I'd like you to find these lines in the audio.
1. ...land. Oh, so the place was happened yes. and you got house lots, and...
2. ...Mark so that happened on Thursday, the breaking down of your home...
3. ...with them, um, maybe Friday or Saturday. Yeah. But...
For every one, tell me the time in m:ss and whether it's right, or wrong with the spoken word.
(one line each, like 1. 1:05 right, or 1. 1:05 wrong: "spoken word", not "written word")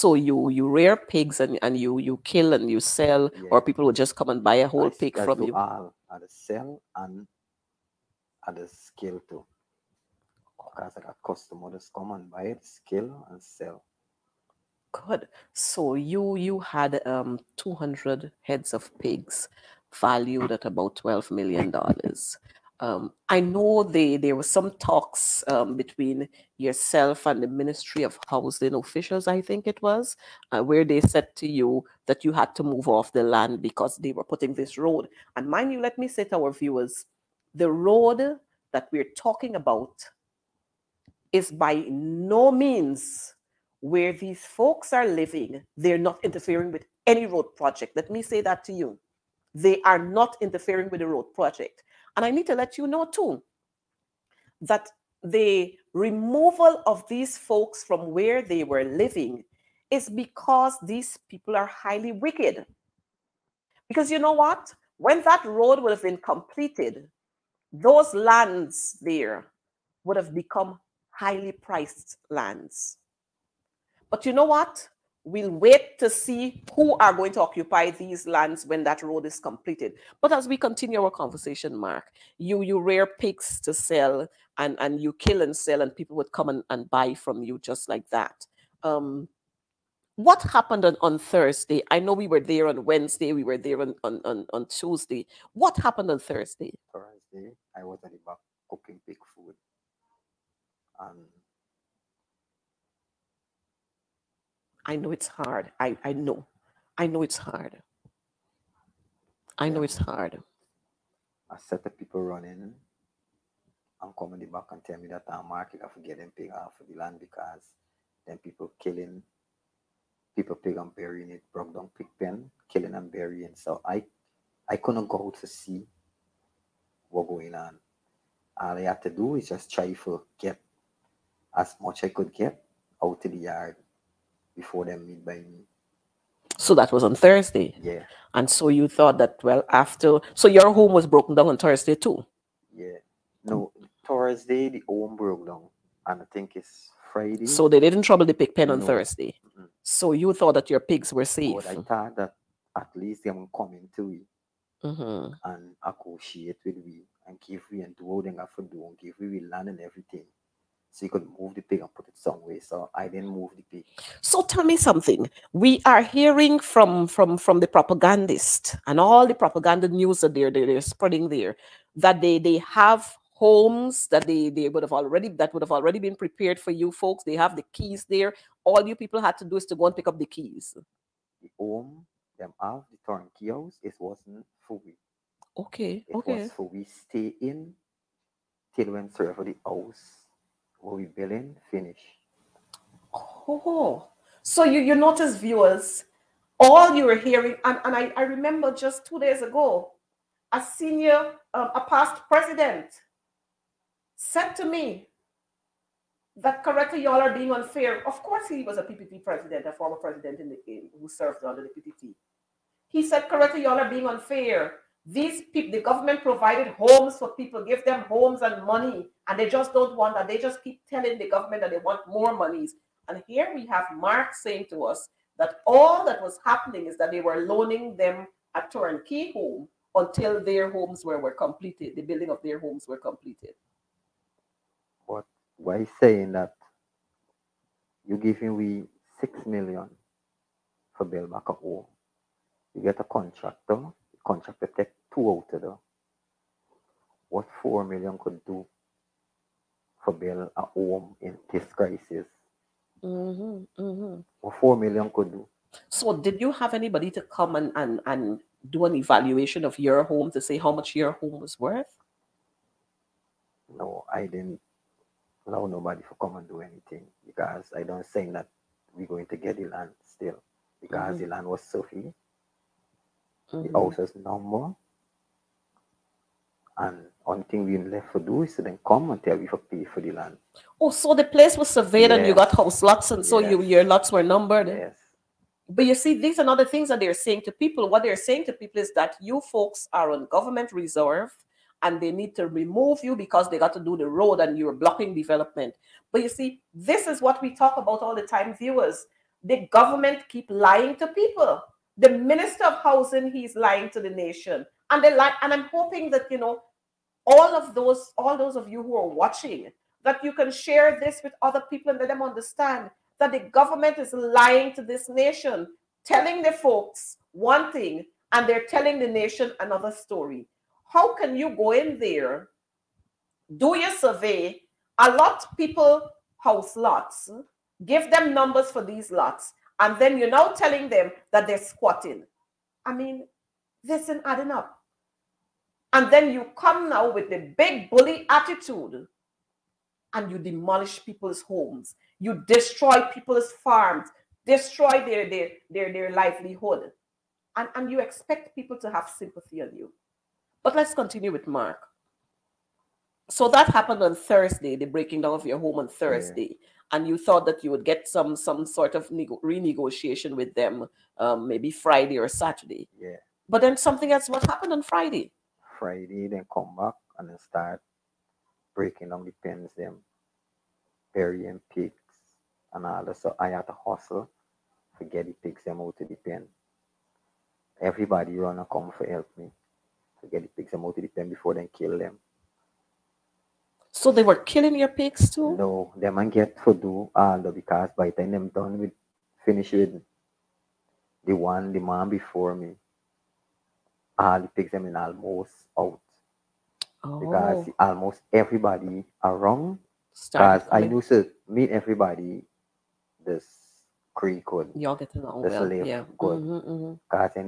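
1. 4:40 wrong: "surveyed", not "happened"
2. 5:51 right
3. 6:00 right.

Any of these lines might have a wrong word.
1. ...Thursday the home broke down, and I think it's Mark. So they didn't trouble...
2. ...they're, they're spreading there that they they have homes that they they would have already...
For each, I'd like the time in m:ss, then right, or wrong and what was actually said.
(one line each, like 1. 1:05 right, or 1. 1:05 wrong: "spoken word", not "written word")
1. 2:24 wrong: "Friday", not "Mark"
2. 2:50 right.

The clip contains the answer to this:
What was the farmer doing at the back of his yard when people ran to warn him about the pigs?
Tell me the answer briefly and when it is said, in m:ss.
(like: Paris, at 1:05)
Cooking pig food, at 1:38.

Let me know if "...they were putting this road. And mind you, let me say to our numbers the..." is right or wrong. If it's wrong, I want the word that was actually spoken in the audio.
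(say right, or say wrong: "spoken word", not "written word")
wrong: "viewers", not "numbers".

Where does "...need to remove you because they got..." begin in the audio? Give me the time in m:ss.
4:52.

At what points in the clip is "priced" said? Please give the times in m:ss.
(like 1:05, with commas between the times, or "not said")
1:11.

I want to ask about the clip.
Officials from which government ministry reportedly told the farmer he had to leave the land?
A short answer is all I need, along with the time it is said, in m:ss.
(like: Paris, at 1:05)
Ministry of Housing, at 0:27.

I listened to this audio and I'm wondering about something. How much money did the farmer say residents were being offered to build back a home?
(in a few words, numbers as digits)
6 million.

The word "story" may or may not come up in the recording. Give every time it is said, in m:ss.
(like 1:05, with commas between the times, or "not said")
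5:19.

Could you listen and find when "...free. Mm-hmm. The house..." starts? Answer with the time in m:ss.
4:31.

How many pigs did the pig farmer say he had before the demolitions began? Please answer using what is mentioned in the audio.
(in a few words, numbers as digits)
200.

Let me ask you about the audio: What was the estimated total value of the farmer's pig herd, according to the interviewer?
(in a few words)
$12 million.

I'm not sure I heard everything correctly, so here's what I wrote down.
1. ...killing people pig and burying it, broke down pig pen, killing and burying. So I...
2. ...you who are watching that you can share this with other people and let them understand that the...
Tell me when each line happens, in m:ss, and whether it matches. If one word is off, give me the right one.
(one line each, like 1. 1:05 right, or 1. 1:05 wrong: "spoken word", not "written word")
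1. 1:58 right
2. 5:08 right.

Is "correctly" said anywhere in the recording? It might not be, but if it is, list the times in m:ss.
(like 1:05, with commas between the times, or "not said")
3:26, 3:33.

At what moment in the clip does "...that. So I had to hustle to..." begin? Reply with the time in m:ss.
6:13.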